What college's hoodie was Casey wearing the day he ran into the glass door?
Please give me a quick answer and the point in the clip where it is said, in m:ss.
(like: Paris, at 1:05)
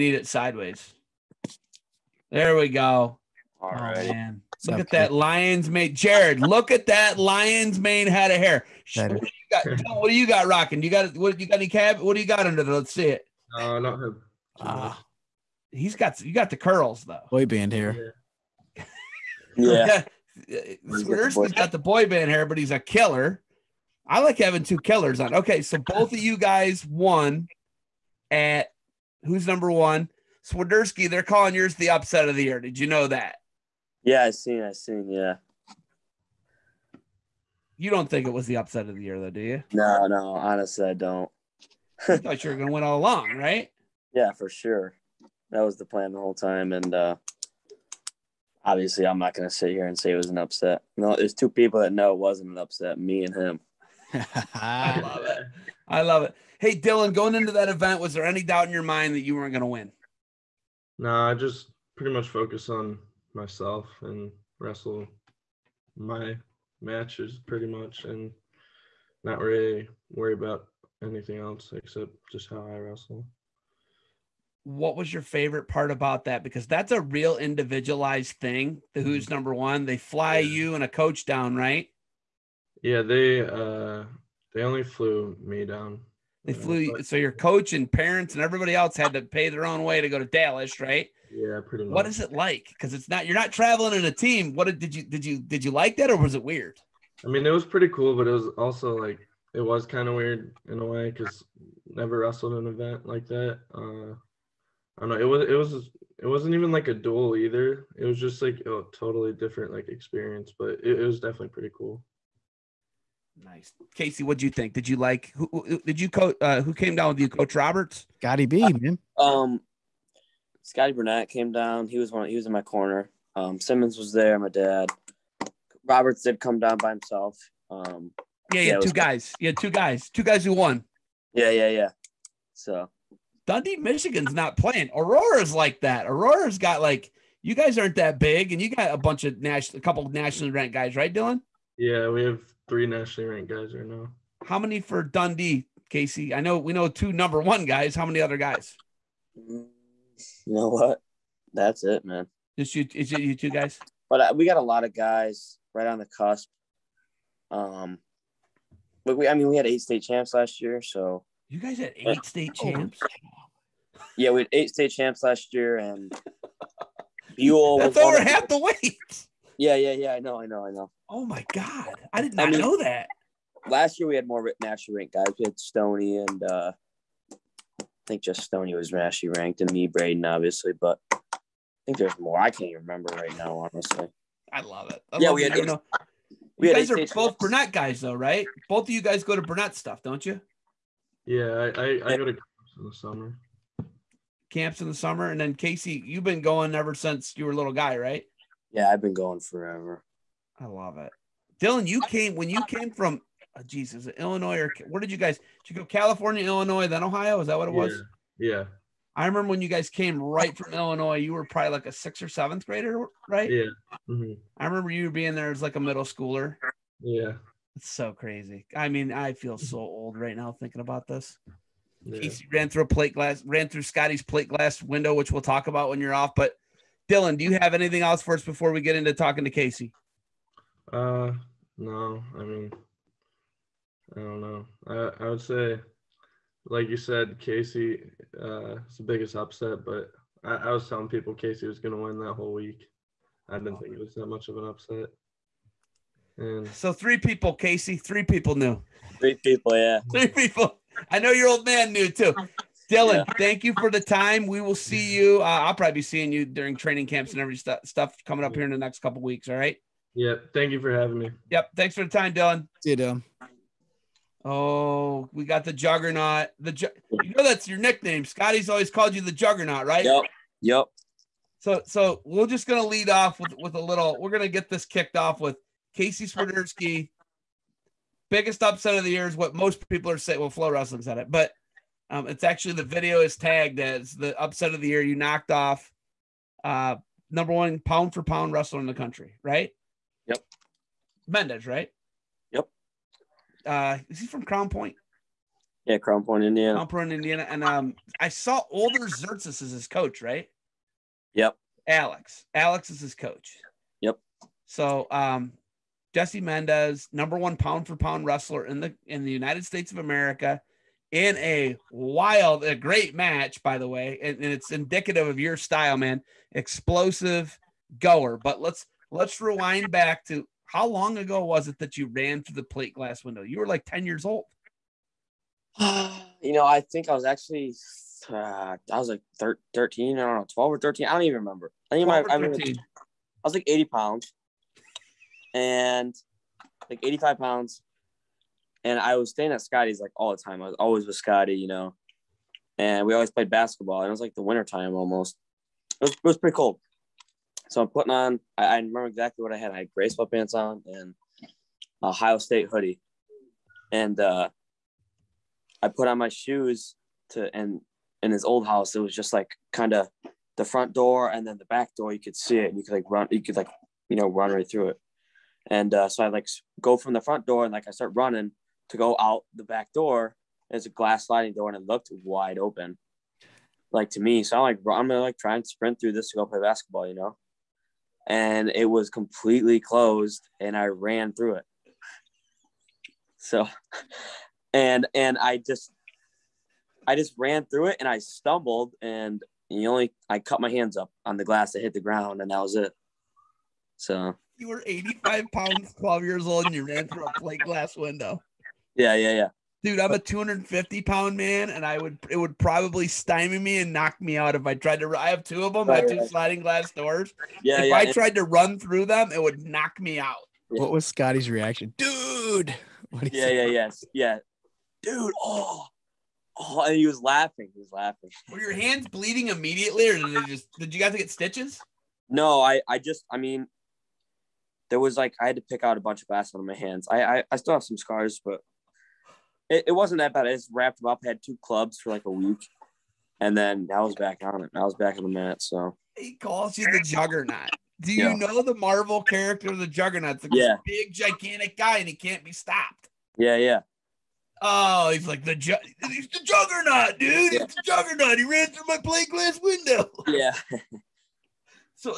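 Ohio State, at 5:52.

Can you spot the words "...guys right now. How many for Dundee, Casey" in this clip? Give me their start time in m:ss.
2:23.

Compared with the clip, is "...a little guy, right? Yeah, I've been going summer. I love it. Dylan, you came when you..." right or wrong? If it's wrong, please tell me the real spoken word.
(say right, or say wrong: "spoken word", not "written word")
wrong: "forever", not "summer".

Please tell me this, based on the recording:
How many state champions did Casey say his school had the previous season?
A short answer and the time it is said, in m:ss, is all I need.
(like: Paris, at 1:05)
8, at 2:39.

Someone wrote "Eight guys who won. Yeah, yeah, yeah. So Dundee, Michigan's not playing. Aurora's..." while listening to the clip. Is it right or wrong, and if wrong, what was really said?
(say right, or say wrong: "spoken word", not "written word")
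wrong: "Two", not "Eight".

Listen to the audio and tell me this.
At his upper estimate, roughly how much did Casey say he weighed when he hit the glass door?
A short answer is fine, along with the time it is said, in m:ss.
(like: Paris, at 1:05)
85 pounds, at 5:37.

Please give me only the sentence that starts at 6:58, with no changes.
Were your hands bleeding immediately, or did just?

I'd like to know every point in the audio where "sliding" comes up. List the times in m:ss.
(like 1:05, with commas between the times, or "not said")
6:11, 6:46.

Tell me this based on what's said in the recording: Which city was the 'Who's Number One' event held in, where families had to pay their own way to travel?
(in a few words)
Dallas.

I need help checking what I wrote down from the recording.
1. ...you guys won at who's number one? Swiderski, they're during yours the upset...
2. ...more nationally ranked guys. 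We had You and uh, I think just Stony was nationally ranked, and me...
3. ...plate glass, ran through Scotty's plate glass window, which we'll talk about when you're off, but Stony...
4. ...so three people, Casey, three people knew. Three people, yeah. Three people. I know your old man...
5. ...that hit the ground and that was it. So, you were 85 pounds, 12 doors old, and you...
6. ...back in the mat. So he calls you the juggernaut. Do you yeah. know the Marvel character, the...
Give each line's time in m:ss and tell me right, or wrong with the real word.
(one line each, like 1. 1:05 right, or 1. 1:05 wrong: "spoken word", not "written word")
1. 0:26 wrong: "calling", not "during"
2. 2:54 wrong: "Stony", not "You"
3. 3:42 wrong: "Dylan", not "Stony"
4. 4:06 right
5. 6:31 wrong: "years", not "doors"
6. 7:14 right.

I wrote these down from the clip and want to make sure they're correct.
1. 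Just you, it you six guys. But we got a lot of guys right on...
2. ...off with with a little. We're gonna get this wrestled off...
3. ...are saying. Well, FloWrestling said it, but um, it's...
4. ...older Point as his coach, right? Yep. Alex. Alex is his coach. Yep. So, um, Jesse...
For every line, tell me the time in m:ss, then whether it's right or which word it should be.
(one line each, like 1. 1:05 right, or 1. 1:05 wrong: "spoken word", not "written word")
1. 2:32 wrong: "two", not "six"
2. 4:33 wrong: "kicked", not "wrestled"
3. 4:40 right
4. 4:58 wrong: "Tsirtsis", not "Point".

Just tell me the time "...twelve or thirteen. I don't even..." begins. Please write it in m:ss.
5:30.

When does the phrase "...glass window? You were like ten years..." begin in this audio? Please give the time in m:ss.
5:22.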